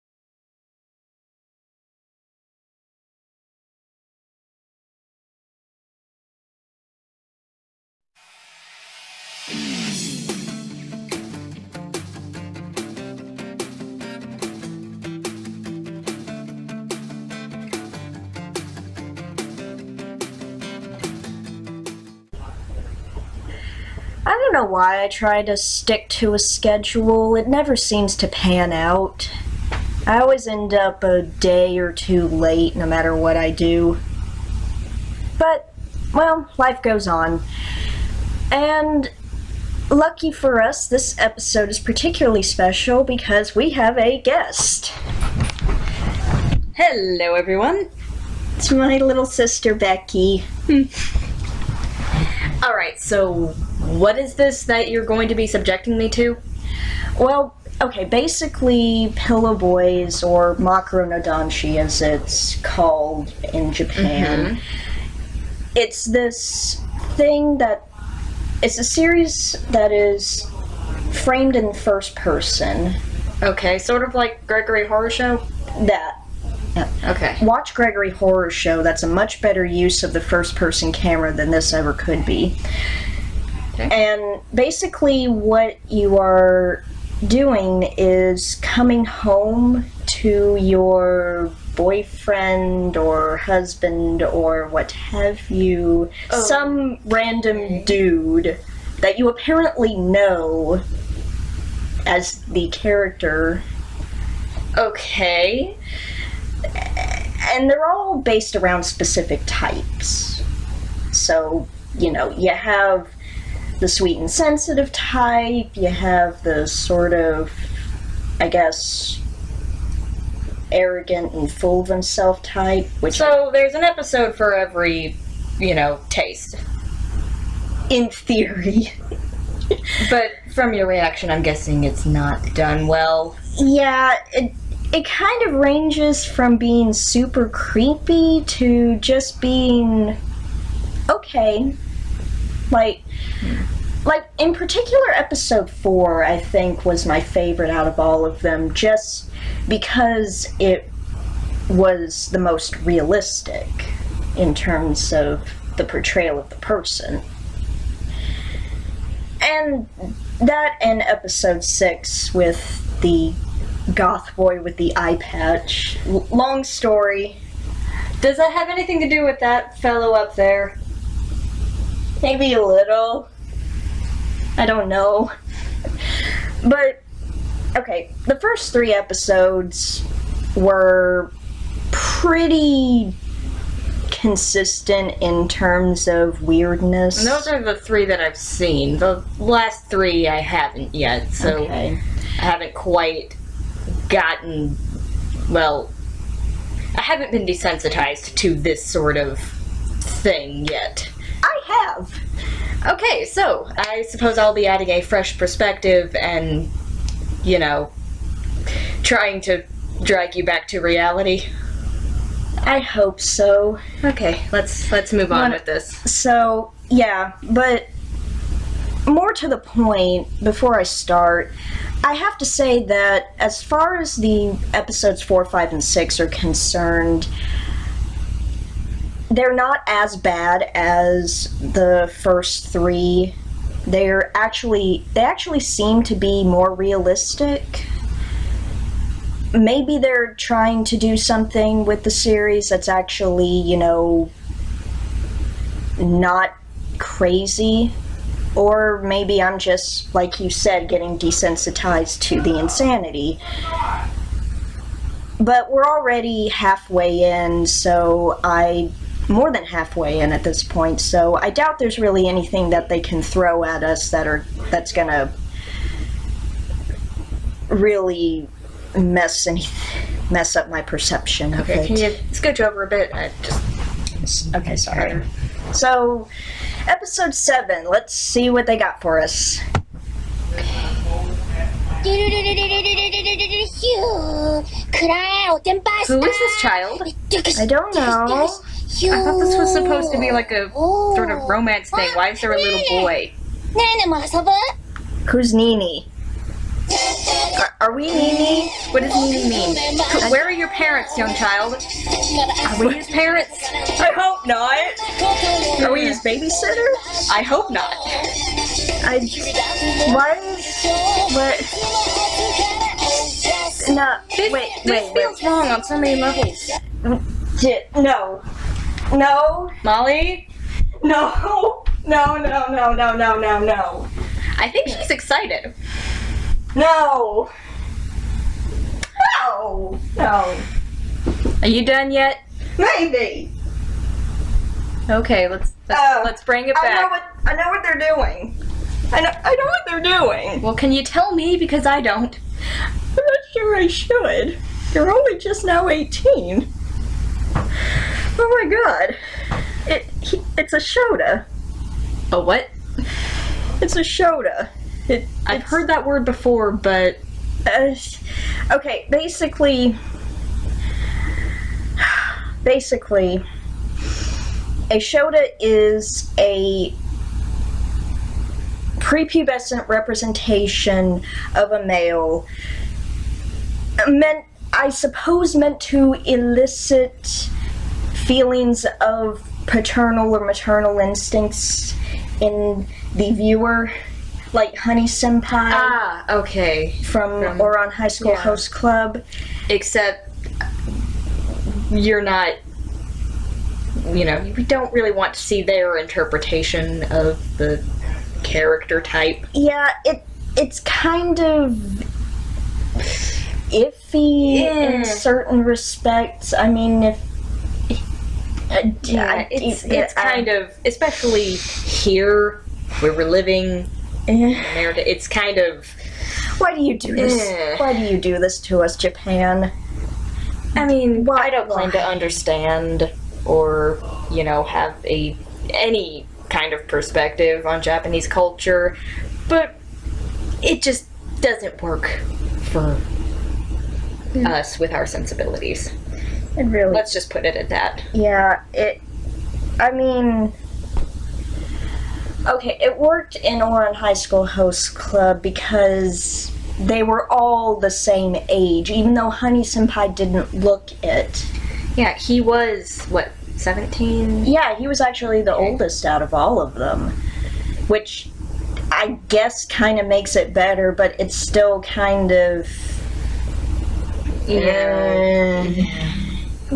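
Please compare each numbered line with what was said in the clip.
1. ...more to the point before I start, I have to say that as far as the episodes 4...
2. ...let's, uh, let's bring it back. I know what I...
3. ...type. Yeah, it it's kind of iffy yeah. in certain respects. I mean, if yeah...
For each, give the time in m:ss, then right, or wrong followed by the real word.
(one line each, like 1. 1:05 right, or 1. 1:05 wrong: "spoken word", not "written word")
1. 3:39 right
2. 5:35 right
3. 6:39 right.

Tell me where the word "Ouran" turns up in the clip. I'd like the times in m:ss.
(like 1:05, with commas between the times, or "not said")
6:27, 7:23.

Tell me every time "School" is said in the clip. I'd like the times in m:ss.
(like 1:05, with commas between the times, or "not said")
6:28, 7:24.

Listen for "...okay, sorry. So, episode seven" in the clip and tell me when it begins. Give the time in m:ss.
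4:34.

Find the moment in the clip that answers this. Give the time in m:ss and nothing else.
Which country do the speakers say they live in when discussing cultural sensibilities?
6:54.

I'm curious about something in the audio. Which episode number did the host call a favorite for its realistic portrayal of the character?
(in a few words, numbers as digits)
4.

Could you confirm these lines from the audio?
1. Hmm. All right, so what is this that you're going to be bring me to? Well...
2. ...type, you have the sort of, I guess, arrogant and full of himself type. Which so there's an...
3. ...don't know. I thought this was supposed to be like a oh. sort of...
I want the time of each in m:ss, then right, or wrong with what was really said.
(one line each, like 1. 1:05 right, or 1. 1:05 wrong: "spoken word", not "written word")
1. 0:50 wrong: "subjecting", not "bring"
2. 1:54 right
3. 4:47 right.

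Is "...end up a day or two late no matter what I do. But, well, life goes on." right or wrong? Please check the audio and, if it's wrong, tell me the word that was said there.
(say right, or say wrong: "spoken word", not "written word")
right.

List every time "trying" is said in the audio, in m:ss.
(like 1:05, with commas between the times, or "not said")
3:29, 4:00.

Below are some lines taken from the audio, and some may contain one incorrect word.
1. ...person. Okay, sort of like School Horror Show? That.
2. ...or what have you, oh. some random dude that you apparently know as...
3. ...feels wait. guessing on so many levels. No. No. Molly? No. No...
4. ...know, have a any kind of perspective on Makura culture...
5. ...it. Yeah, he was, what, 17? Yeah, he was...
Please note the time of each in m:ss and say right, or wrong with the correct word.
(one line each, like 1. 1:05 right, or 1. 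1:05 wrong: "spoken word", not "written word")
1. 1:12 wrong: "Gregory", not "School"
2. 1:34 right
3. 5:15 wrong: "wrong", not "guessing"
4. 7:04 wrong: "Japanese", not "Makura"
5. 7:31 right.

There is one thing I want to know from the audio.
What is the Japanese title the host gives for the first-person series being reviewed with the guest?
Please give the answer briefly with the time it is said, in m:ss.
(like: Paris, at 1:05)
Makura no Danshi, at 1:00.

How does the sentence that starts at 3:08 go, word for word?
The last three I haven't yet, so okay.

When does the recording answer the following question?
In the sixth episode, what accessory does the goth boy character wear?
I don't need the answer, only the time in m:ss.
2:44.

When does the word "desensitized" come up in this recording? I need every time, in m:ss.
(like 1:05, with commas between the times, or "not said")
3:17, 4:11.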